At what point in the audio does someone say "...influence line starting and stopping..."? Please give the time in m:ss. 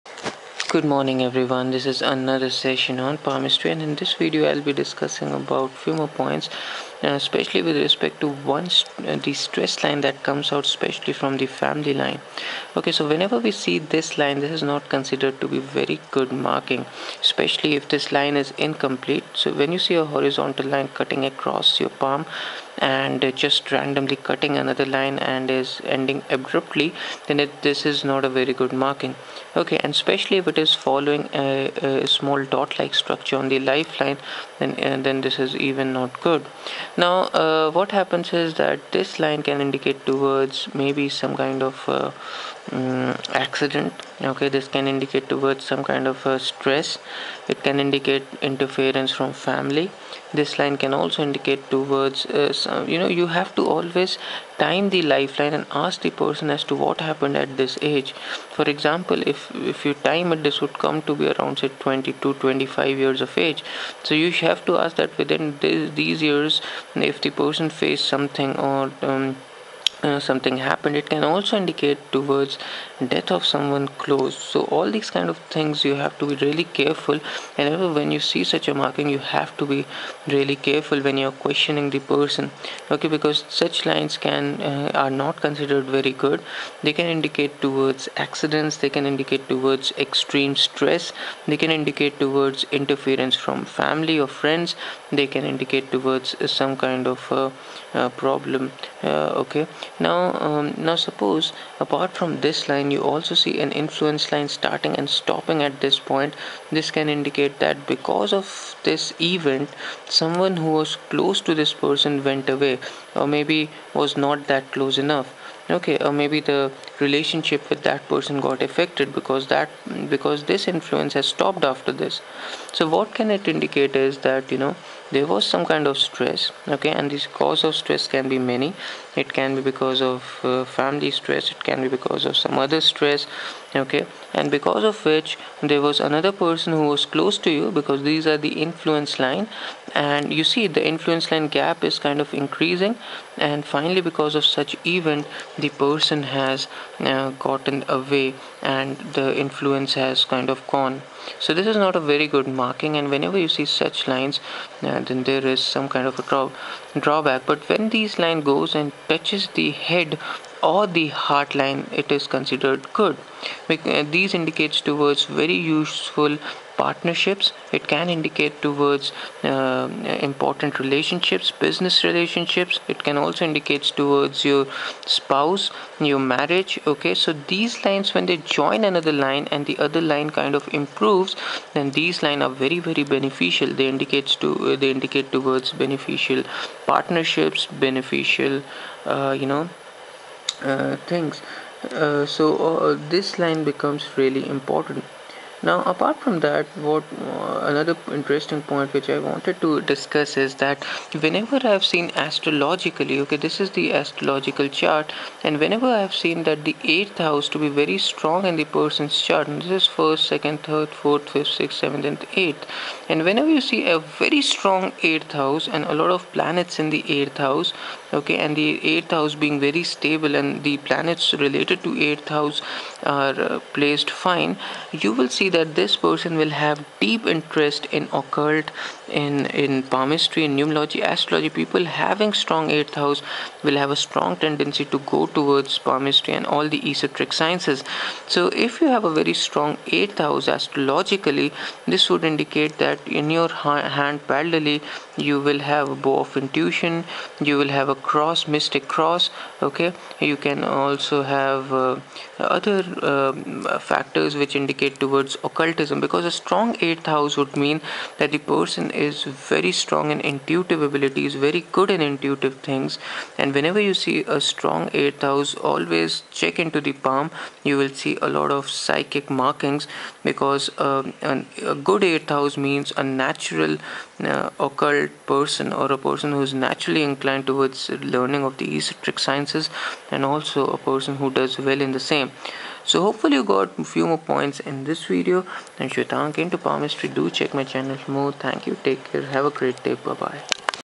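1:43.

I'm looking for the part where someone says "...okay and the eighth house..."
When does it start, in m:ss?
3:38.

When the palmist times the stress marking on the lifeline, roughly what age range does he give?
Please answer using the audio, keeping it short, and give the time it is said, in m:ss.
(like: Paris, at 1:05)
22 to 25 years, at 1:01.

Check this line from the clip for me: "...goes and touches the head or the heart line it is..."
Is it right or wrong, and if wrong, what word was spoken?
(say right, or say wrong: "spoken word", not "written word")
right.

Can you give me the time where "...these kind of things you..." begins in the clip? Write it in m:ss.
1:14.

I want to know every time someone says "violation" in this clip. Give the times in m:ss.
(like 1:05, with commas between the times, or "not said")
not said.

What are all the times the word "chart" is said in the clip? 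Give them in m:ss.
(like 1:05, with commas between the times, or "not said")
3:24, 3:29.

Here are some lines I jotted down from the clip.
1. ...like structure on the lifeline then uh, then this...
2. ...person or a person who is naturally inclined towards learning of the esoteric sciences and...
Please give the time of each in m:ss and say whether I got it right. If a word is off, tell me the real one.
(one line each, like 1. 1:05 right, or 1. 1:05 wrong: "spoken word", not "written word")
1. 0:32 right
2. 4:35 right.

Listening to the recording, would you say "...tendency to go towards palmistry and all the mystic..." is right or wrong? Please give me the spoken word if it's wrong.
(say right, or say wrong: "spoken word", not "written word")
wrong: "esoteric", not "mystic".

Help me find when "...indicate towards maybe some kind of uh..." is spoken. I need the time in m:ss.
0:39.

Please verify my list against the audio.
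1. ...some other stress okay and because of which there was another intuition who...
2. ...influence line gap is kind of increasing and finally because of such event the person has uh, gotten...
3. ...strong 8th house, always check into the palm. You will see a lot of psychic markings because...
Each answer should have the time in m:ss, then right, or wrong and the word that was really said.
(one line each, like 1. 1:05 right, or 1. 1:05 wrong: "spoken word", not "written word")
1. 2:12 wrong: "person", not "intuition"
2. 2:20 right
3. 4:24 right.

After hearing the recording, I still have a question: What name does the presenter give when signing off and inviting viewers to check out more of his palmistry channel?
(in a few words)
Shwetank.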